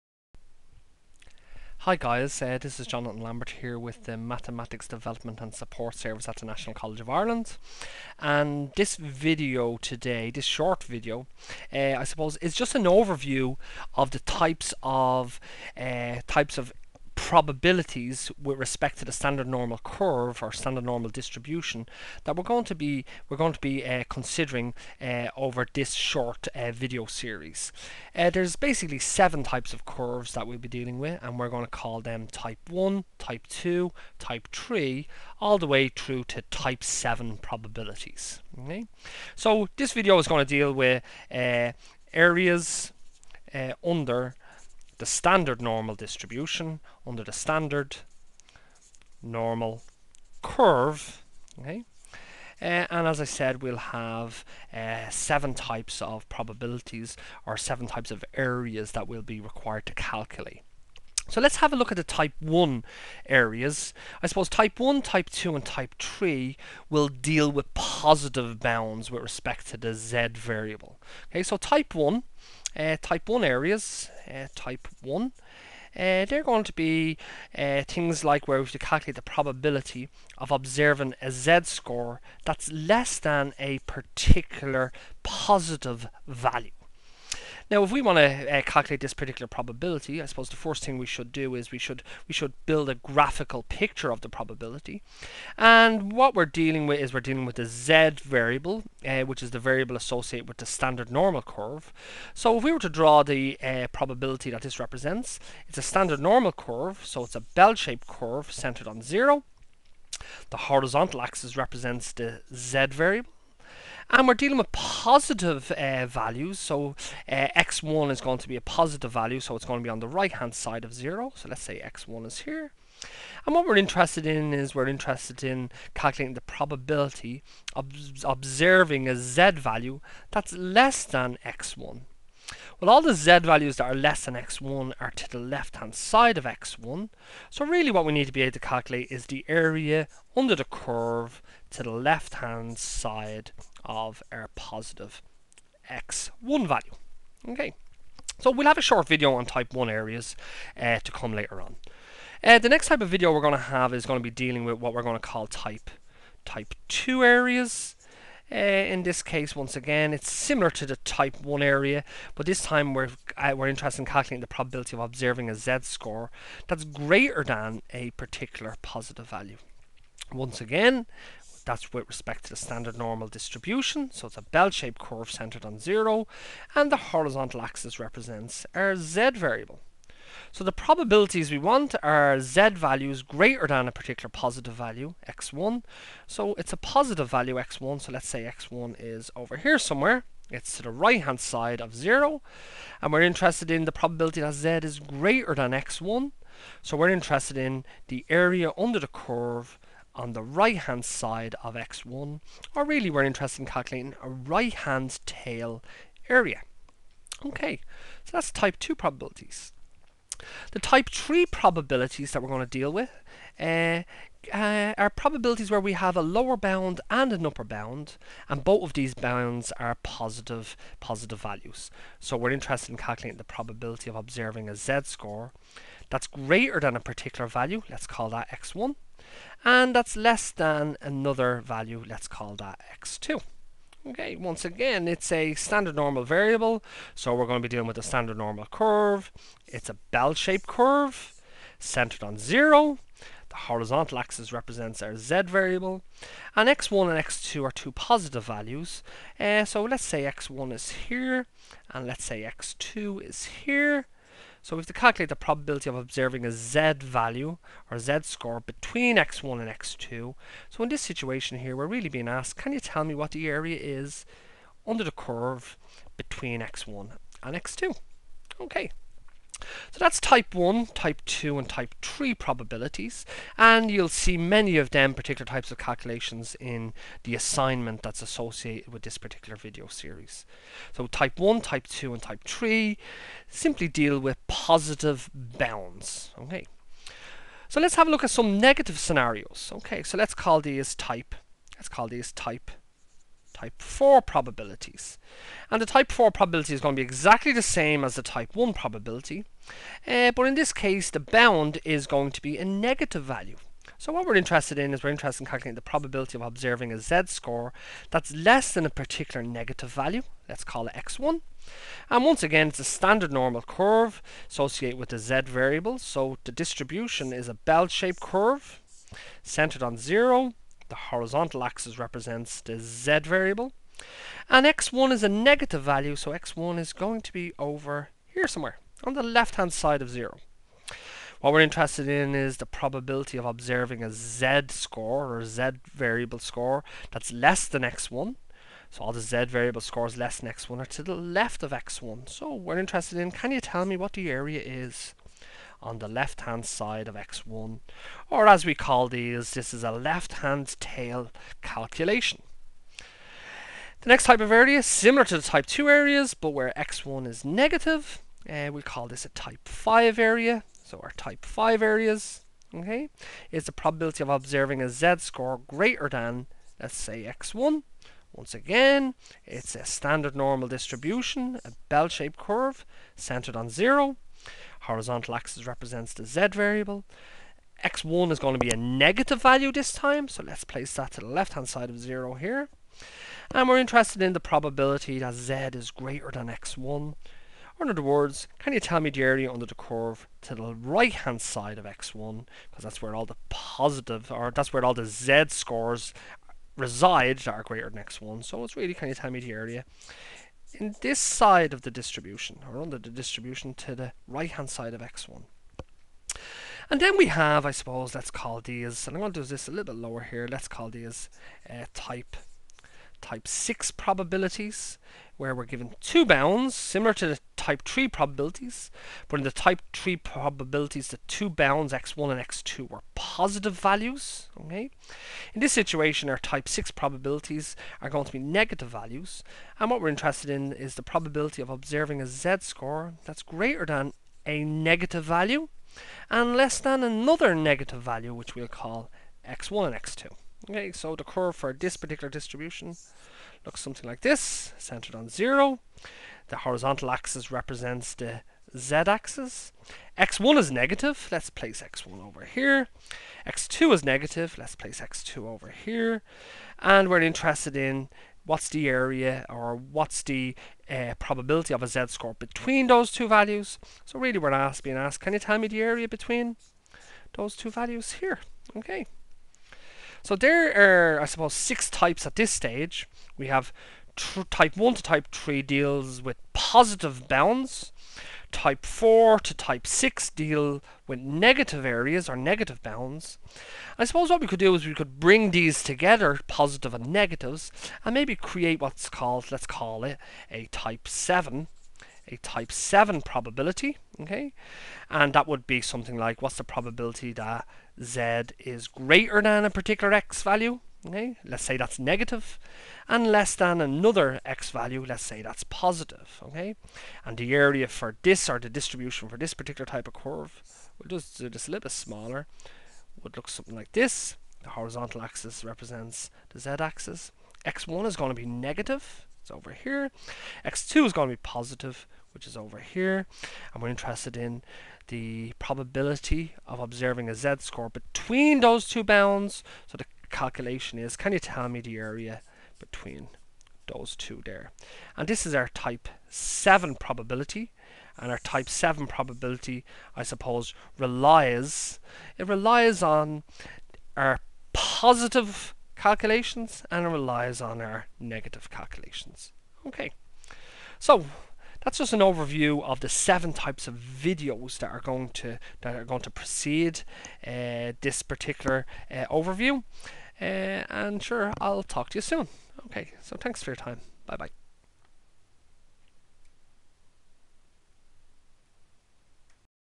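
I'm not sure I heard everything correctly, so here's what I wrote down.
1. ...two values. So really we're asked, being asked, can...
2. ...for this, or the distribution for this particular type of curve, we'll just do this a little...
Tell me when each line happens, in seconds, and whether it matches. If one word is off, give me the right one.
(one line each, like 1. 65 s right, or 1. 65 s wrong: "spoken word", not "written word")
1. 463 s right
2. 507 s right.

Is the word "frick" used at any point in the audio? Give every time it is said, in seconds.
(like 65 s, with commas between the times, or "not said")
not said.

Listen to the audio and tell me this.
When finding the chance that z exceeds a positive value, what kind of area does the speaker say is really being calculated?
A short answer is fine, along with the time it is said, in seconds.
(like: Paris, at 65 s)
right hand tail area, at 204 s.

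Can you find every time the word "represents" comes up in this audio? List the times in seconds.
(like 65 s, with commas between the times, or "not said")
104 s, 111 s, 177 s, 244 s, 321 s, 375 s, 447 s, 515 s.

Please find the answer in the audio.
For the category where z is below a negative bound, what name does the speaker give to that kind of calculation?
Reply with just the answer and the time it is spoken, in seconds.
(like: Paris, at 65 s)
left hand tail calculation, at 349 s.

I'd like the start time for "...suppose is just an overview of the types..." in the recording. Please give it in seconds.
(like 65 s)
12 s.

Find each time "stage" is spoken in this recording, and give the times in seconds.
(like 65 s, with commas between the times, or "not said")
472 s.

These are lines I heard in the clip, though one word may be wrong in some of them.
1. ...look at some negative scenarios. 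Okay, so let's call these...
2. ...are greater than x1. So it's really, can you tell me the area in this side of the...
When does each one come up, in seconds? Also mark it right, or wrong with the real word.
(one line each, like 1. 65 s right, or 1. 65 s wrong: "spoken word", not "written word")
1. 288 s right
2. 397 s right.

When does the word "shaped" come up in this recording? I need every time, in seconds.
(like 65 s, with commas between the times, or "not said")
107 s, 174 s, 240 s, 317 s, 371 s.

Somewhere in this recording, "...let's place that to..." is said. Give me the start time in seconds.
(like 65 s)
380 s.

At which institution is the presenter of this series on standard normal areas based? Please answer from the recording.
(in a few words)
National College of Ireland.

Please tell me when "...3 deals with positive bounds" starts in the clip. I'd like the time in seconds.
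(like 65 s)
475 s.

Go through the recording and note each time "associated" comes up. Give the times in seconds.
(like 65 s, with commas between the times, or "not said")
99 s, 278 s, 314 s.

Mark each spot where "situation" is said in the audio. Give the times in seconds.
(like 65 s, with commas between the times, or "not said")
261 s, 425 s.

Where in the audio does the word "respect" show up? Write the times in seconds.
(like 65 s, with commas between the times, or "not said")
18 s, 69 s, 172 s.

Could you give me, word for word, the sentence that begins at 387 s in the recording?
Or in other words, can you tell me the area under the curve to the right-hand side of x1?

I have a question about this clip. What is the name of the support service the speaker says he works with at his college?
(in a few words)
Mathematics Development and Support Service.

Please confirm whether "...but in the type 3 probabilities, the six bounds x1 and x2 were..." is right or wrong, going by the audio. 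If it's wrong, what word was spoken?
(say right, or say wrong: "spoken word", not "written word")
wrong: "two", not "six".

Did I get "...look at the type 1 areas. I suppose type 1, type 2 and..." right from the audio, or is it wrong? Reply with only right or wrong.
right.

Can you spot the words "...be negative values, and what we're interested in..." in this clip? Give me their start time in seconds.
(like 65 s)
428 s.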